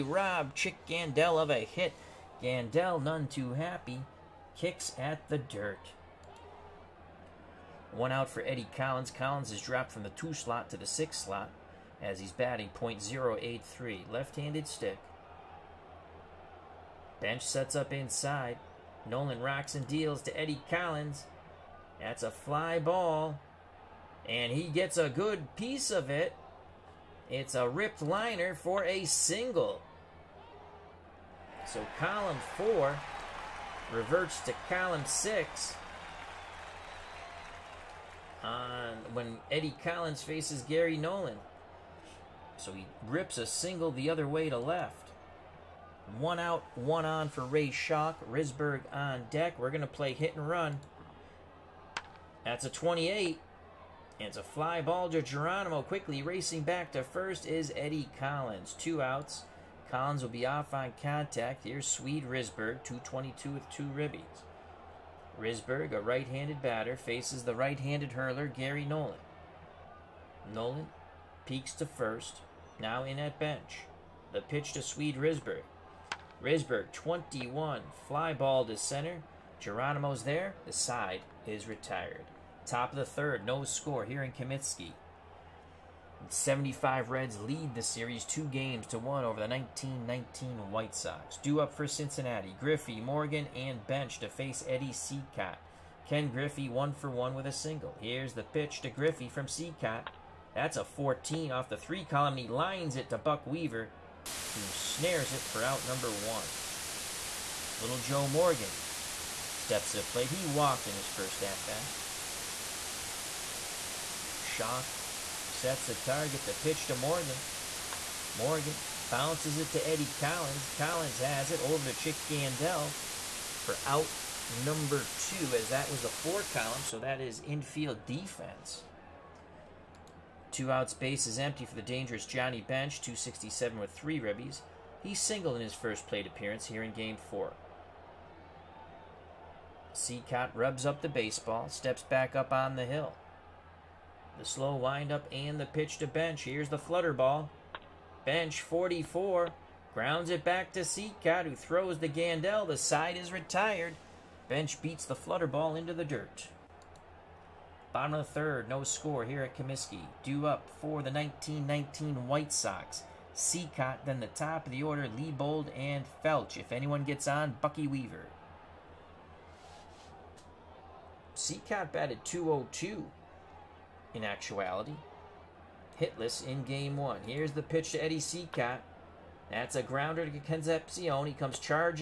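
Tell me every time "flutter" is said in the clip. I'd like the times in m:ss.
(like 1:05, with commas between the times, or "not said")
2:26, 2:35.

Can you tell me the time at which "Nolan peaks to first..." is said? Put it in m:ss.
1:10.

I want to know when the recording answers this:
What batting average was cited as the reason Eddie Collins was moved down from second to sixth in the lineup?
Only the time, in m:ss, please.
0:12.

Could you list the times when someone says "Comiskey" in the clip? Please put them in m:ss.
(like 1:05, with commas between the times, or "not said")
1:24, 2:39.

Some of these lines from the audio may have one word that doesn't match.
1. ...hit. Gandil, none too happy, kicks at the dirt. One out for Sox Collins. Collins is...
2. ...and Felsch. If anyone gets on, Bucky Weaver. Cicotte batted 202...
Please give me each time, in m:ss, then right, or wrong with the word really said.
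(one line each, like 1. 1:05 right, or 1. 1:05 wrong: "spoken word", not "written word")
1. 0:01 wrong: "Eddie", not "Sox"
2. 2:45 right.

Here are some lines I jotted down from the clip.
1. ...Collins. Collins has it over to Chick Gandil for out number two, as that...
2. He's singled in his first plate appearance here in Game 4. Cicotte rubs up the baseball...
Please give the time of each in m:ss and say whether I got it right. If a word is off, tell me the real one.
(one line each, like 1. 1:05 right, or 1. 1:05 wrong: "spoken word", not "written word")
1. 2:00 right
2. 2:15 right.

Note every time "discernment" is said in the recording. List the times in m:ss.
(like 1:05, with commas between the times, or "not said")
not said.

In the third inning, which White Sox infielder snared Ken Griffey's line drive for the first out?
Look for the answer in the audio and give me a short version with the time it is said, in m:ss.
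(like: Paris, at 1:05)
Buck Weaver, at 1:43.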